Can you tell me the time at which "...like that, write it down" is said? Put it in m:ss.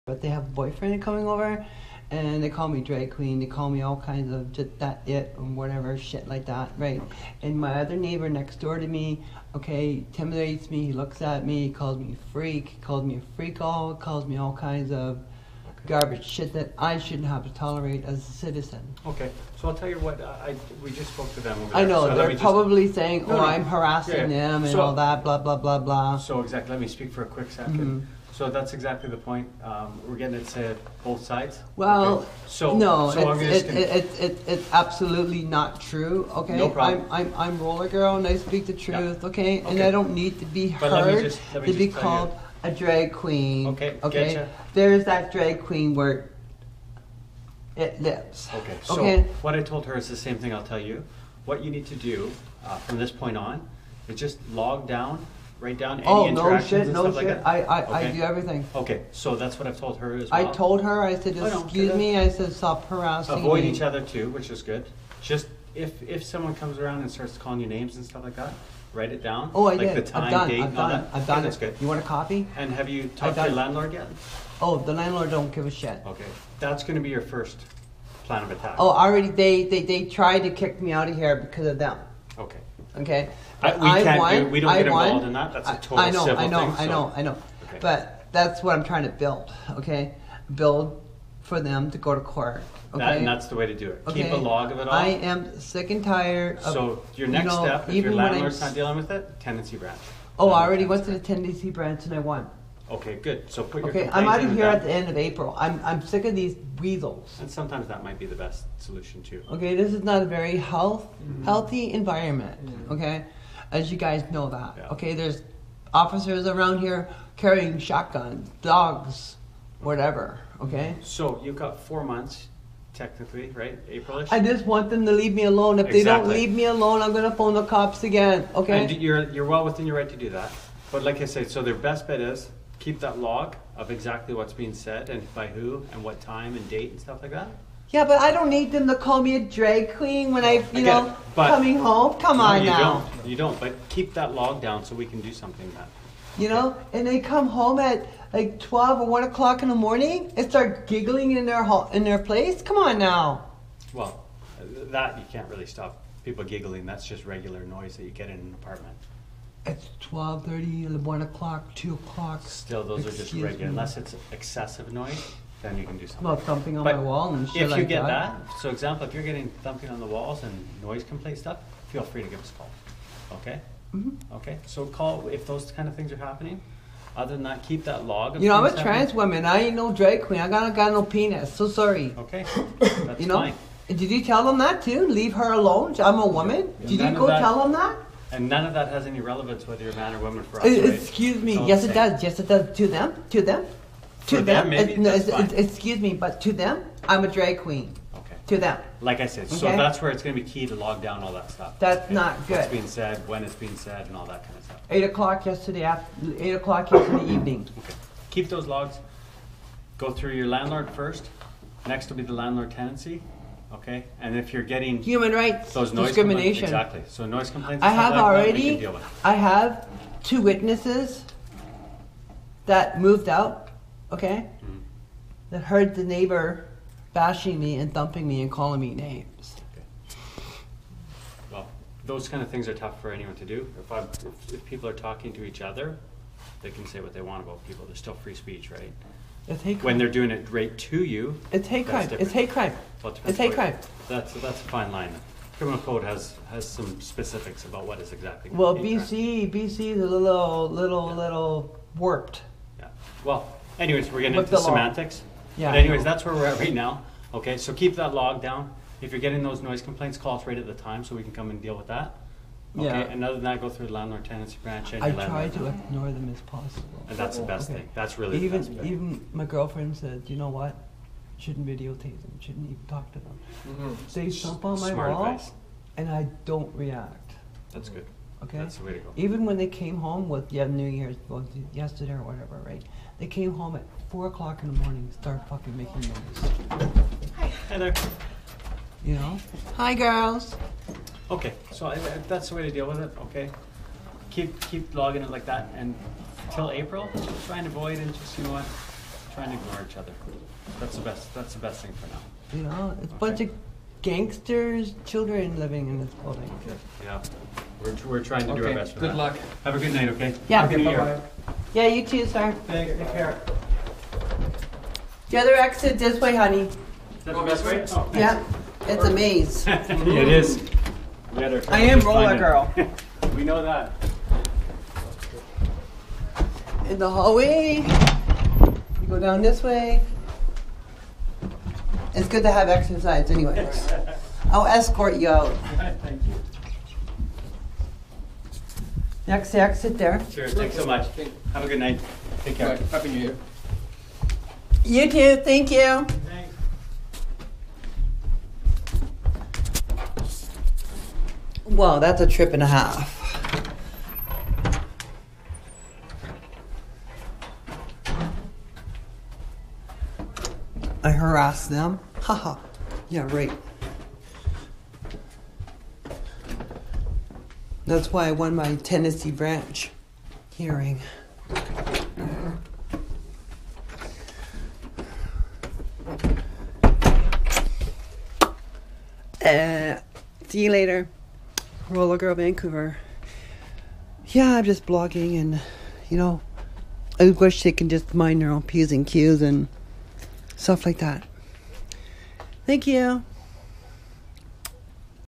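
1:08.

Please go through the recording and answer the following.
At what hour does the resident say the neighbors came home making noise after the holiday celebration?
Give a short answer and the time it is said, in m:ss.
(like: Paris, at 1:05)
4 o'clock in the morning, at 4:44.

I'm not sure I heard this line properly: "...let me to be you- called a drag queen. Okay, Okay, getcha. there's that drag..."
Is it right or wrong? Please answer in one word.
right.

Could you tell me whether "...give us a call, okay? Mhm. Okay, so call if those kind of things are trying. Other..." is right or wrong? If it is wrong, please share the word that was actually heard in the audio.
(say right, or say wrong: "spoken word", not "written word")
wrong: "happening", not "trying".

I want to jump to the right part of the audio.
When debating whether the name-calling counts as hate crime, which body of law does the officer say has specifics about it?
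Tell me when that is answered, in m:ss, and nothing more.
4:05.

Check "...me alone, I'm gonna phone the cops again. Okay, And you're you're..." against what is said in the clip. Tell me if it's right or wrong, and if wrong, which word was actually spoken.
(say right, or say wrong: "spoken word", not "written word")
right.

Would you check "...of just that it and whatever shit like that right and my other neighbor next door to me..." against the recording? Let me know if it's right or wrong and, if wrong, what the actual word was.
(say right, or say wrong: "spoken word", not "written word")
right.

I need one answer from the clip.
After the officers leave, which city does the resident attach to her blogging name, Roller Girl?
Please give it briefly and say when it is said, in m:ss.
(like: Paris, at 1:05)
Vancouver, at 6:22.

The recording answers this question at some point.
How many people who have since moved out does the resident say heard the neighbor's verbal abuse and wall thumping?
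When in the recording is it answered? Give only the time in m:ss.
3:40.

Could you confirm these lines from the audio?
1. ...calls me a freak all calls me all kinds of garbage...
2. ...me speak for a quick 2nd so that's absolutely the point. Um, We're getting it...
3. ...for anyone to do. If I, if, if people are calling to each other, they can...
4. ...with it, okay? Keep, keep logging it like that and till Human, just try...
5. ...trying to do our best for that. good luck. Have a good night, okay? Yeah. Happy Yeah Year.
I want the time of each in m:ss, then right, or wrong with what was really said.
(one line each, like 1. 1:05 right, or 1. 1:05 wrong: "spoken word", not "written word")
1. 0:12 right
2. 0:26 wrong: "exactly", not "absolutely"
3. 3:53 wrong: "talking", not "calling"
4. 4:52 wrong: "April", not "Human"
5. 5:08 wrong: "New", not "Yeah".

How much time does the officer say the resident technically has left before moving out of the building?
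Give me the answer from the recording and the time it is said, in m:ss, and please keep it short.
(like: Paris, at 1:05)
4 months, at 2:01.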